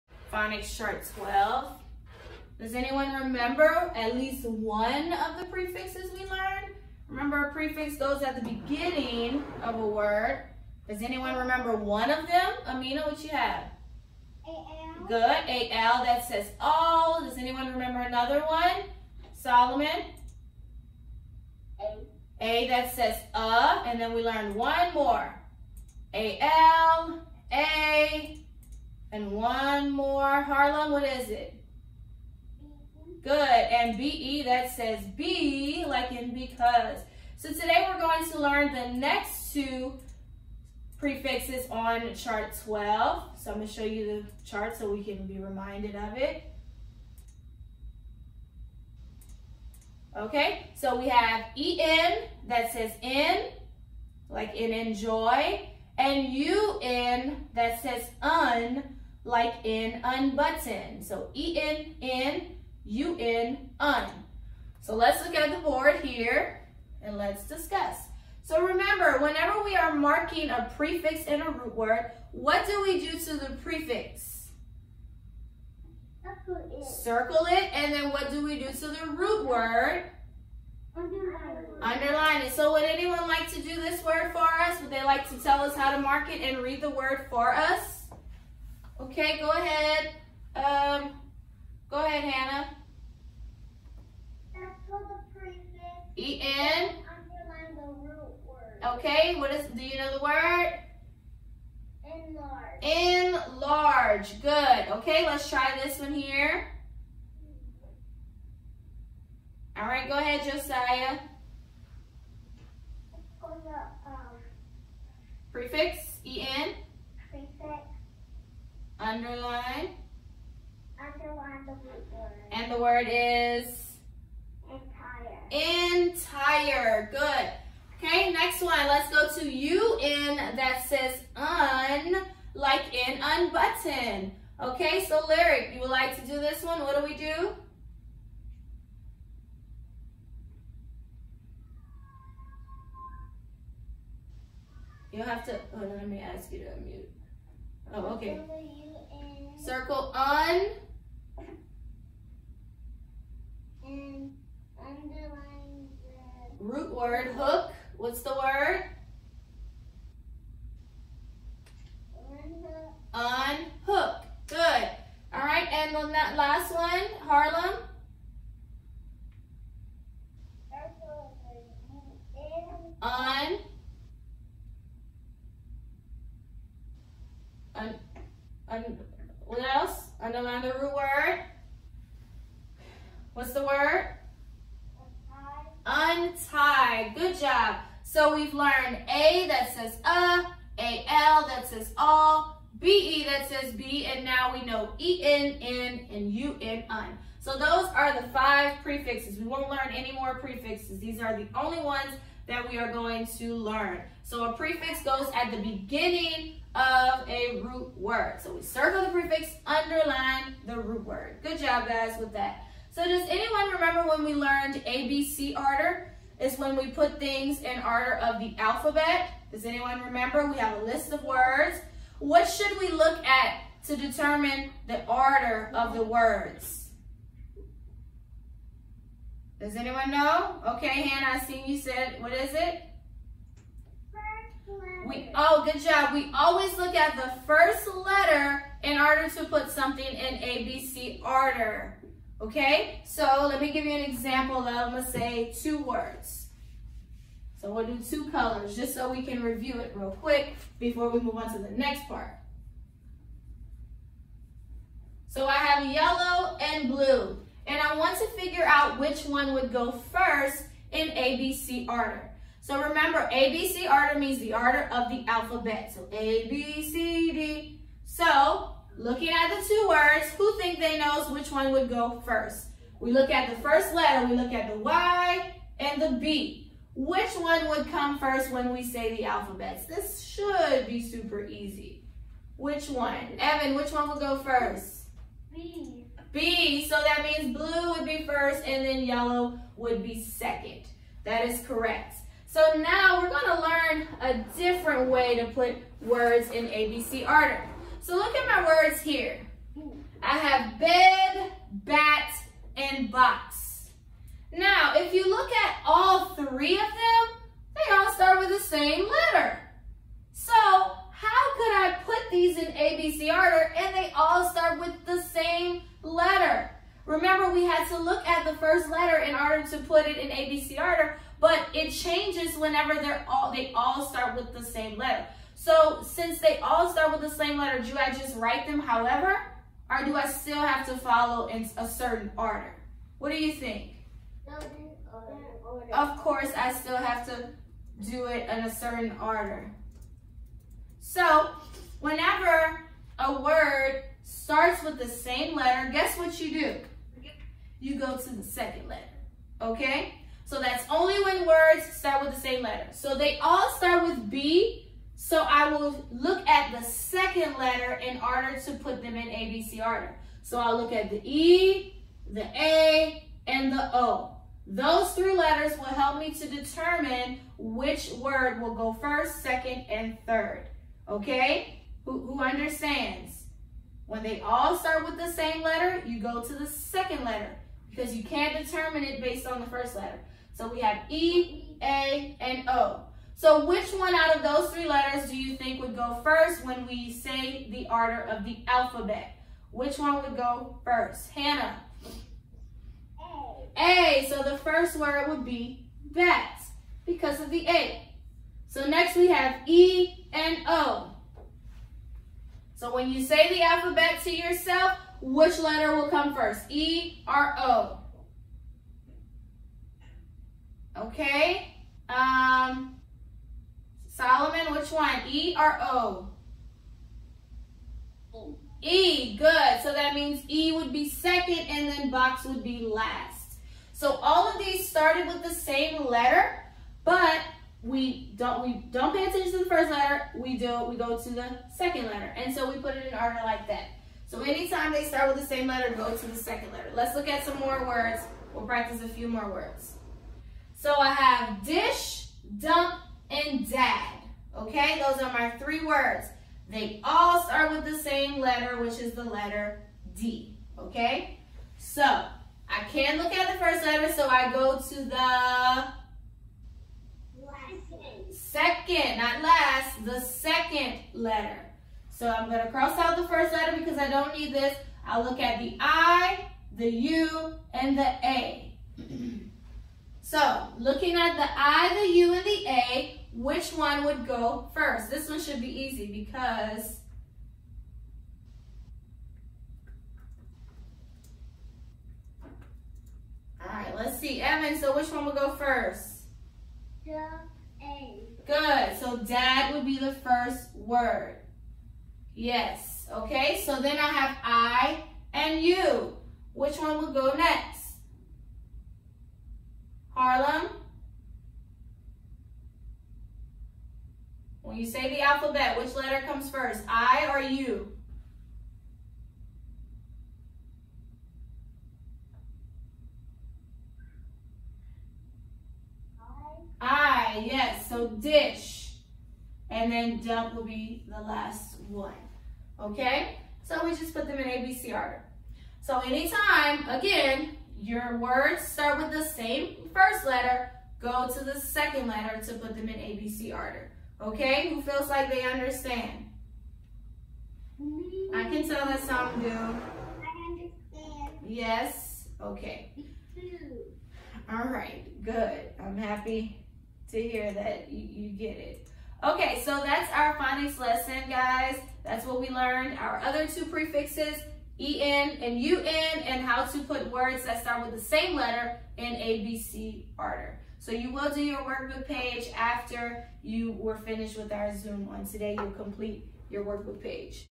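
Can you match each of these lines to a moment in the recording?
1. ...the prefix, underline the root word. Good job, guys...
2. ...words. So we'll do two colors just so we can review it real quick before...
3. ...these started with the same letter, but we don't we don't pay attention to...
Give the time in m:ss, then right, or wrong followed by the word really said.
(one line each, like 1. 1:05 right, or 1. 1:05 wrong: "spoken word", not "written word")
1. 3:29 right
2. 4:05 right
3. 7:04 right.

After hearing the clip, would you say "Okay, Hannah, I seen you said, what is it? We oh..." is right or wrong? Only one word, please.
right.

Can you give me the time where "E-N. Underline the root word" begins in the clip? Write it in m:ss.
1:36.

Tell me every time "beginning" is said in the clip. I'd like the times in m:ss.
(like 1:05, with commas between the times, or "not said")
0:08, 3:25.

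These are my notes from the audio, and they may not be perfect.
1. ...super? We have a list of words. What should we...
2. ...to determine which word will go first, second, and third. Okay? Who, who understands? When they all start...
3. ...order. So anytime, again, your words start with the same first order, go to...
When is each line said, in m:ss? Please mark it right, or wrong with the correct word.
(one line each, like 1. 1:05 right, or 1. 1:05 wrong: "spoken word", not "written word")
1. 3:39 wrong: "remember", not "super"
2. 6:06 right
3. 8:44 wrong: "letter", not "order".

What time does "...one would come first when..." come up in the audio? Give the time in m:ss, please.
4:37.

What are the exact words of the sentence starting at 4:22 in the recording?
So remember, ABC order means the order of the alphabet.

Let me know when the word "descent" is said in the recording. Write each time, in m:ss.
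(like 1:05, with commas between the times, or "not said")
not said.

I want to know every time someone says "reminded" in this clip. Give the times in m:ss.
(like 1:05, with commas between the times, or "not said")
0:45.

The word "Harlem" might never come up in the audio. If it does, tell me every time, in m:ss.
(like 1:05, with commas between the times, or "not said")
0:30, 2:47, 8:20.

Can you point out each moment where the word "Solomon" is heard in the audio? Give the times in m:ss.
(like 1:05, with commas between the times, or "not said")
0:19, 6:54.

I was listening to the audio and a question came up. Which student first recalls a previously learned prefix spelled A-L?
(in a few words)
Amina.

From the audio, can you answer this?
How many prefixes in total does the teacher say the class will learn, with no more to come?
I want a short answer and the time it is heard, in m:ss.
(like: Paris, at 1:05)
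5, at 3:18.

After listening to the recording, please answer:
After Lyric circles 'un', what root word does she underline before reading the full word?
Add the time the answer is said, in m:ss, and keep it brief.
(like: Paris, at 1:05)
hook, at 2:37.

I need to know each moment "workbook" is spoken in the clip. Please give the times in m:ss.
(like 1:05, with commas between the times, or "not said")
9:21, 9:26.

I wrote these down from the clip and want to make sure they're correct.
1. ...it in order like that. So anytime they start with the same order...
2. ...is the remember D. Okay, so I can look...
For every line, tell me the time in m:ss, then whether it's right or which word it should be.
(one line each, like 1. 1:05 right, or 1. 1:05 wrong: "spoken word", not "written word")
1. 7:12 wrong: "letter", not "order"
2. 7:28 wrong: "letter", not "remember".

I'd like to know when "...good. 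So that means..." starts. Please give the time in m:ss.
6:59.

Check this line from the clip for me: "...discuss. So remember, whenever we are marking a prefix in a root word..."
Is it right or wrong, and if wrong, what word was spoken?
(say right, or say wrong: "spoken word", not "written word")
right.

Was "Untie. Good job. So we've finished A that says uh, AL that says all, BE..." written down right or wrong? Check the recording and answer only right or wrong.
wrong.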